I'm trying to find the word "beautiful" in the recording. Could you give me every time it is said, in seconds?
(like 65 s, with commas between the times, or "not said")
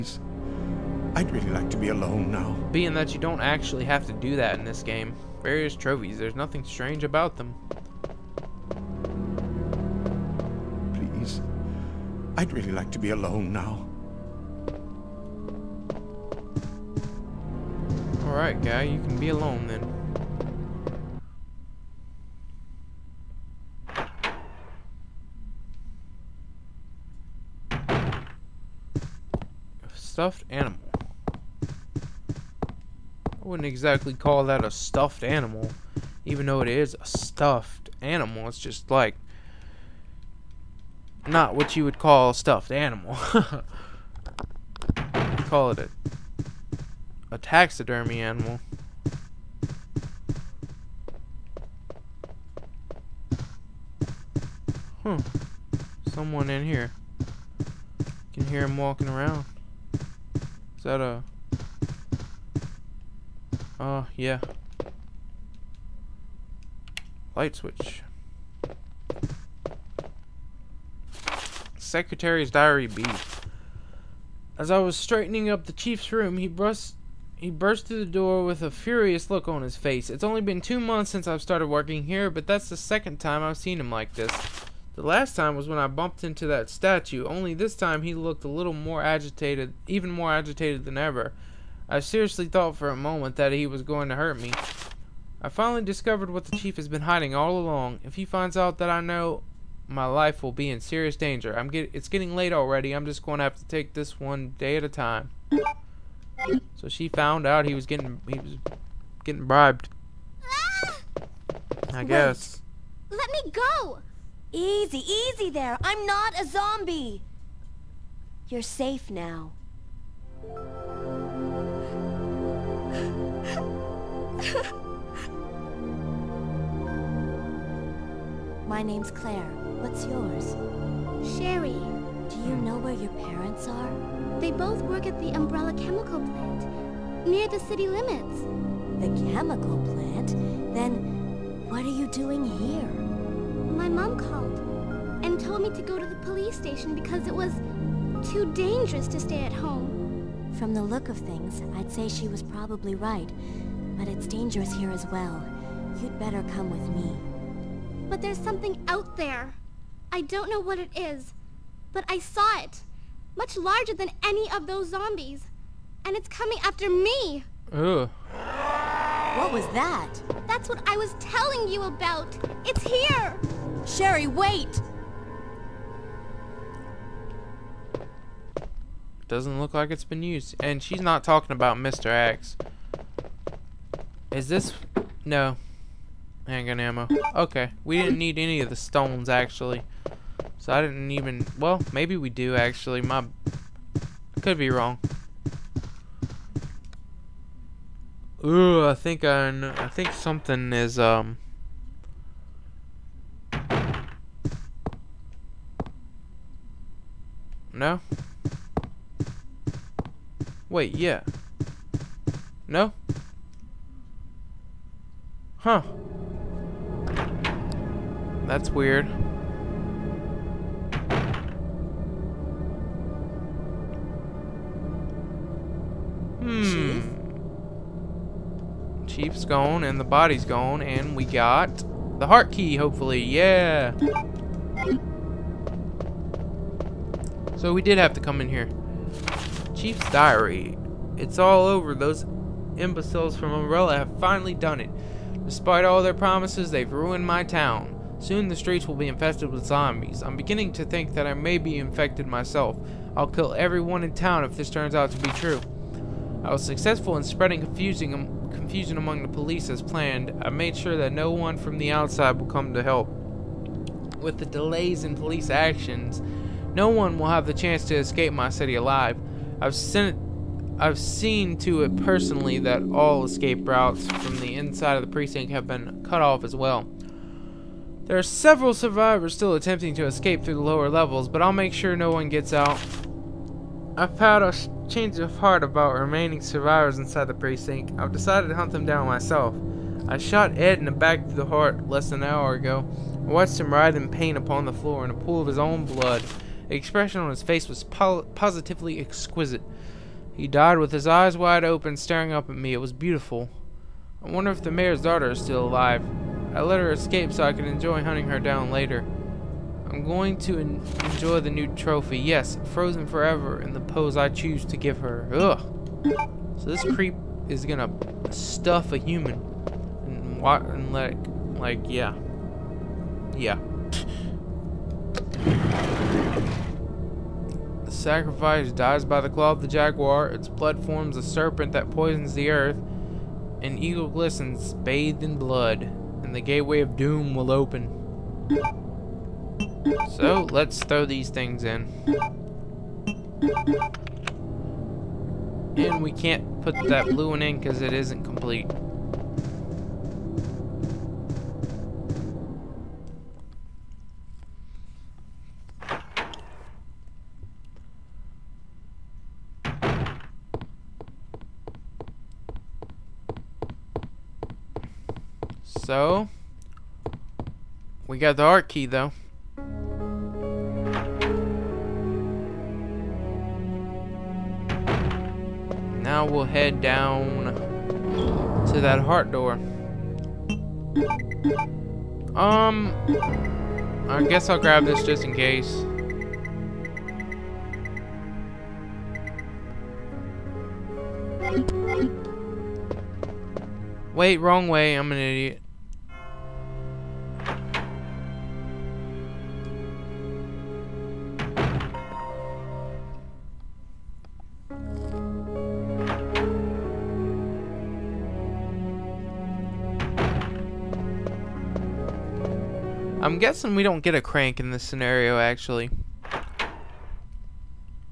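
302 s.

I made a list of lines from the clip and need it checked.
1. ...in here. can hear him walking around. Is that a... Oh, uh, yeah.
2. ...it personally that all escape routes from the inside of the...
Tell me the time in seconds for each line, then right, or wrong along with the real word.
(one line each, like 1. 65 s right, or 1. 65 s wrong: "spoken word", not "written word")
1. 56 s right
2. 271 s right.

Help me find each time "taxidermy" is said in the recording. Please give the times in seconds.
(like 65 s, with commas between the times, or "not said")
47 s.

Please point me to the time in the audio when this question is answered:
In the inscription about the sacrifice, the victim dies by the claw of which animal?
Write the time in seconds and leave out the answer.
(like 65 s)
329 s.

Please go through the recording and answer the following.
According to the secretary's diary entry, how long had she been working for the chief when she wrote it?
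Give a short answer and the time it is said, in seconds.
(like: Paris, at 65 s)
2 months, at 80 s.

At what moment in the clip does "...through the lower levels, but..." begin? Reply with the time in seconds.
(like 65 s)
280 s.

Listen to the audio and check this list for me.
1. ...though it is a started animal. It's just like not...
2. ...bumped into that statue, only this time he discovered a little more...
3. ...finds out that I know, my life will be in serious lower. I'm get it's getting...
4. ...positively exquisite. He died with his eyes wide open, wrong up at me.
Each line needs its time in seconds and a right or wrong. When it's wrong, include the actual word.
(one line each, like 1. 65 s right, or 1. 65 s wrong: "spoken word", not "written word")
1. 36 s wrong: "stuffed", not "started"
2. 85 s wrong: "looked", not "discovered"
3. 98 s wrong: "danger", not "lower"
4. 298 s wrong: "staring", not "wrong".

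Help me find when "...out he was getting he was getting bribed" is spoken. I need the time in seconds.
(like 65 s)
107 s.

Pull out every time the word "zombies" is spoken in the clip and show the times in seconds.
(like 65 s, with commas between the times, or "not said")
116 s, 164 s, 249 s.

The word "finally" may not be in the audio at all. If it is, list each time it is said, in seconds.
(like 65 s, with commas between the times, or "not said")
95 s, 244 s.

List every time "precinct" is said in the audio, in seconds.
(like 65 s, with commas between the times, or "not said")
275 s, 287 s.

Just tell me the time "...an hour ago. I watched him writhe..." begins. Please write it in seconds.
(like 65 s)
292 s.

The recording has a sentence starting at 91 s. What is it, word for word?
I seriously thought for a moment that he was going to hurt me.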